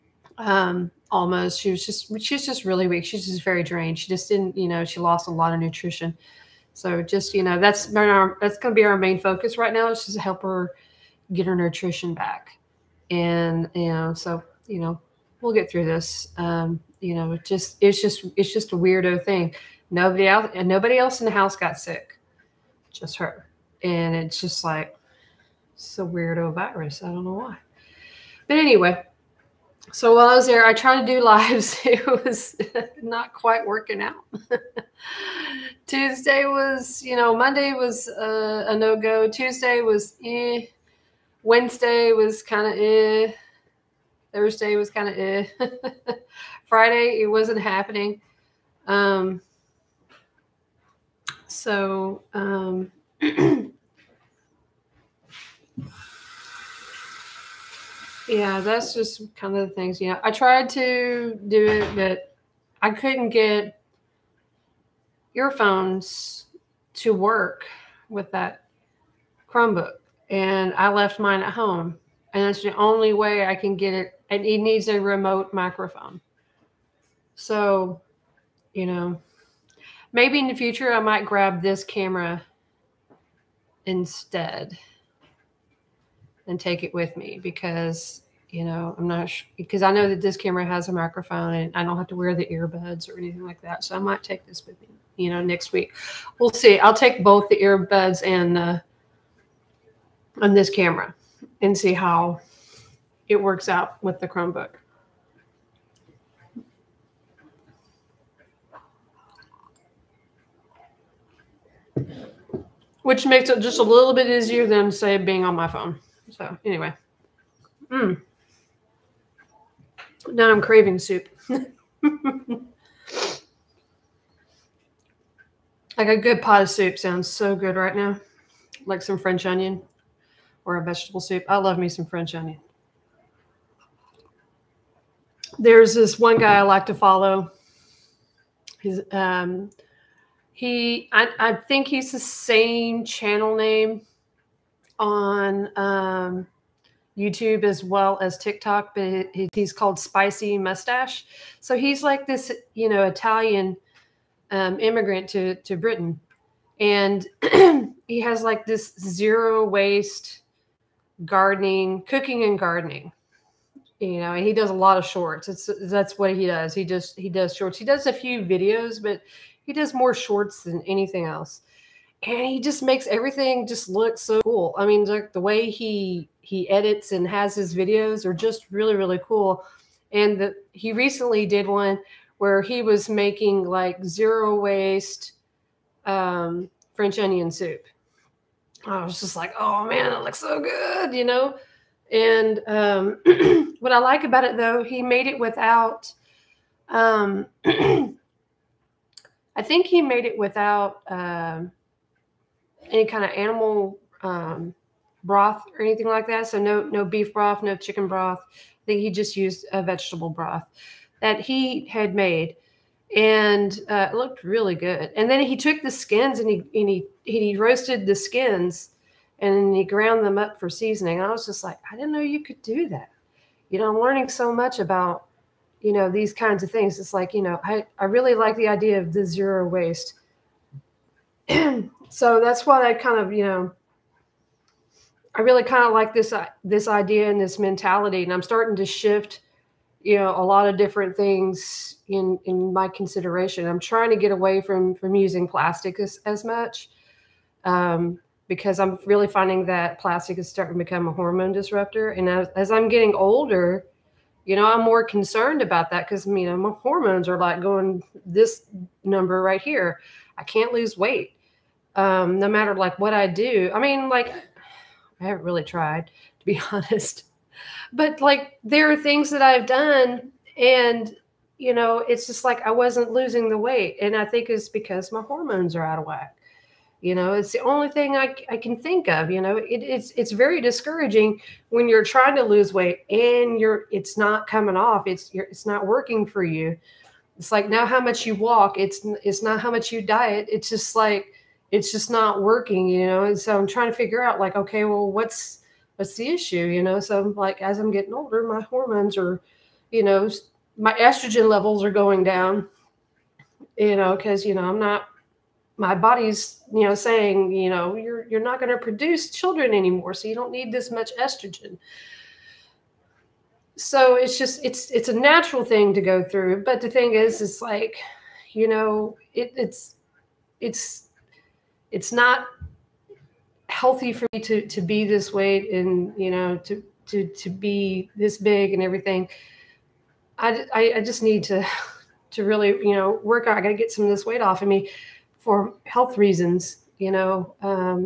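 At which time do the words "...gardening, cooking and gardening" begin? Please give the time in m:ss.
2:41.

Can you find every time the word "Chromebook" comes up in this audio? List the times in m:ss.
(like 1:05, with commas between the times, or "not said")
1:09, 1:44.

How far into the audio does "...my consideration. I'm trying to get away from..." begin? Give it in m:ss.
4:02.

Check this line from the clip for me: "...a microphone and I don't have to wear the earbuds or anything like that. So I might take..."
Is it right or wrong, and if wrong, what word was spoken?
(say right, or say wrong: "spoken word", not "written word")
right.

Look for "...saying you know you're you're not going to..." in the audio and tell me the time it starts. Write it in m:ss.
5:06.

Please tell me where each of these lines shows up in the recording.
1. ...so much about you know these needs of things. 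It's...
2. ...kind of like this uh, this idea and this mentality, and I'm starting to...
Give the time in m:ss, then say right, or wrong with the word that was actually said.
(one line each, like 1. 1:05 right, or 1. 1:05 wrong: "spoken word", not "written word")
1. 3:44 wrong: "kinds", not "needs"
2. 3:55 right.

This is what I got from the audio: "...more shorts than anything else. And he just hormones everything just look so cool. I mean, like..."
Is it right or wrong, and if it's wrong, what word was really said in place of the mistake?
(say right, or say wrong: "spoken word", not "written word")
wrong: "makes", not "hormones".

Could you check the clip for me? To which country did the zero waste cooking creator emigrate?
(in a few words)
Britain.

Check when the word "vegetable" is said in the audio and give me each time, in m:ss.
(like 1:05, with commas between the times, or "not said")
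2:10, 3:29.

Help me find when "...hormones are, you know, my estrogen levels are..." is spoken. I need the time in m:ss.
4:58.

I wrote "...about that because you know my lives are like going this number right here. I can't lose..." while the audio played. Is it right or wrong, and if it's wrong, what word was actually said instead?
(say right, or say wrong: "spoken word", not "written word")
wrong: "hormones", not "lives".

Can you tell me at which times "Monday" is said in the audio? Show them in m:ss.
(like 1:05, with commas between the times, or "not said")
0:37.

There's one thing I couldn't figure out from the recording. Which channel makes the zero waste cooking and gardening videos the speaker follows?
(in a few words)
Spicy Mustache.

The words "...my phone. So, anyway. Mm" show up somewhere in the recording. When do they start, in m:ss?
1:55.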